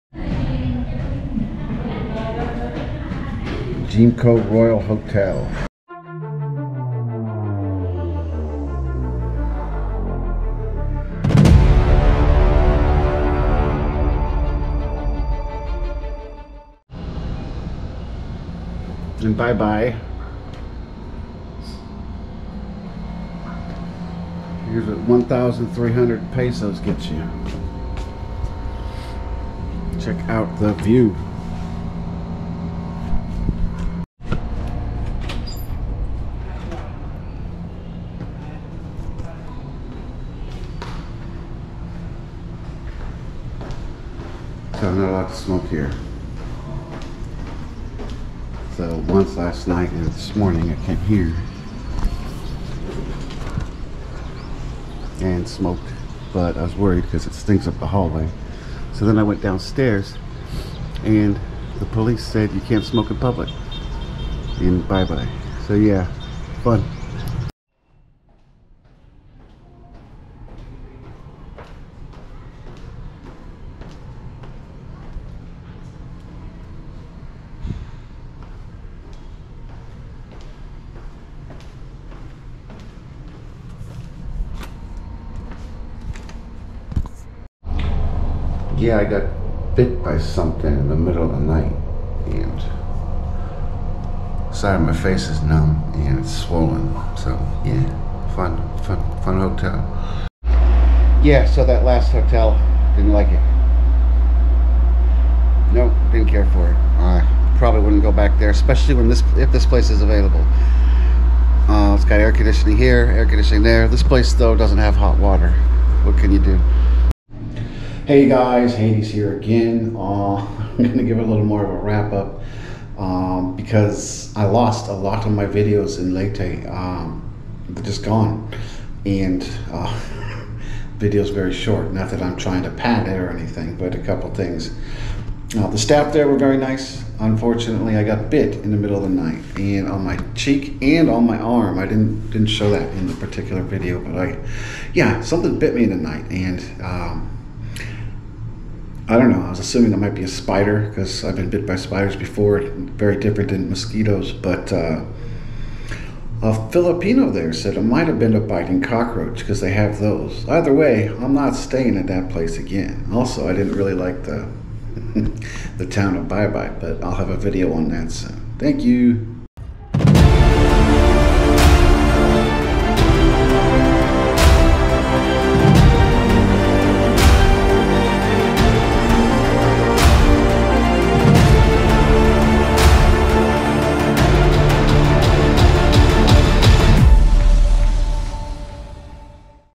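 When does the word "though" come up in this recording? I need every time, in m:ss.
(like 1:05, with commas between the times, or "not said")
1:54.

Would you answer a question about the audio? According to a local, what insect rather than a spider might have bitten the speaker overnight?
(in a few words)
biting cockroach.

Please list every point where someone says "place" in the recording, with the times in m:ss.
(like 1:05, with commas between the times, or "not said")
1:49, 1:54, 2:42.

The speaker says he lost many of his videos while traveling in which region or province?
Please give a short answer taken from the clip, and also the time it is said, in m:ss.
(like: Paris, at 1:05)
Leyte, at 2:06.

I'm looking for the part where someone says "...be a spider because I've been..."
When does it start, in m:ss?
2:30.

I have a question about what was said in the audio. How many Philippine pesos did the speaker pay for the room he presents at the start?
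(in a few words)
1,300 pesos.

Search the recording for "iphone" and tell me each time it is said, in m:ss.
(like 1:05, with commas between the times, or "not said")
not said.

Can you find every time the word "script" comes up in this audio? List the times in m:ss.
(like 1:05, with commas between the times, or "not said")
not said.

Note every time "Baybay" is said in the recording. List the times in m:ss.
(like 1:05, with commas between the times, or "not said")
0:19, 1:04, 2:46.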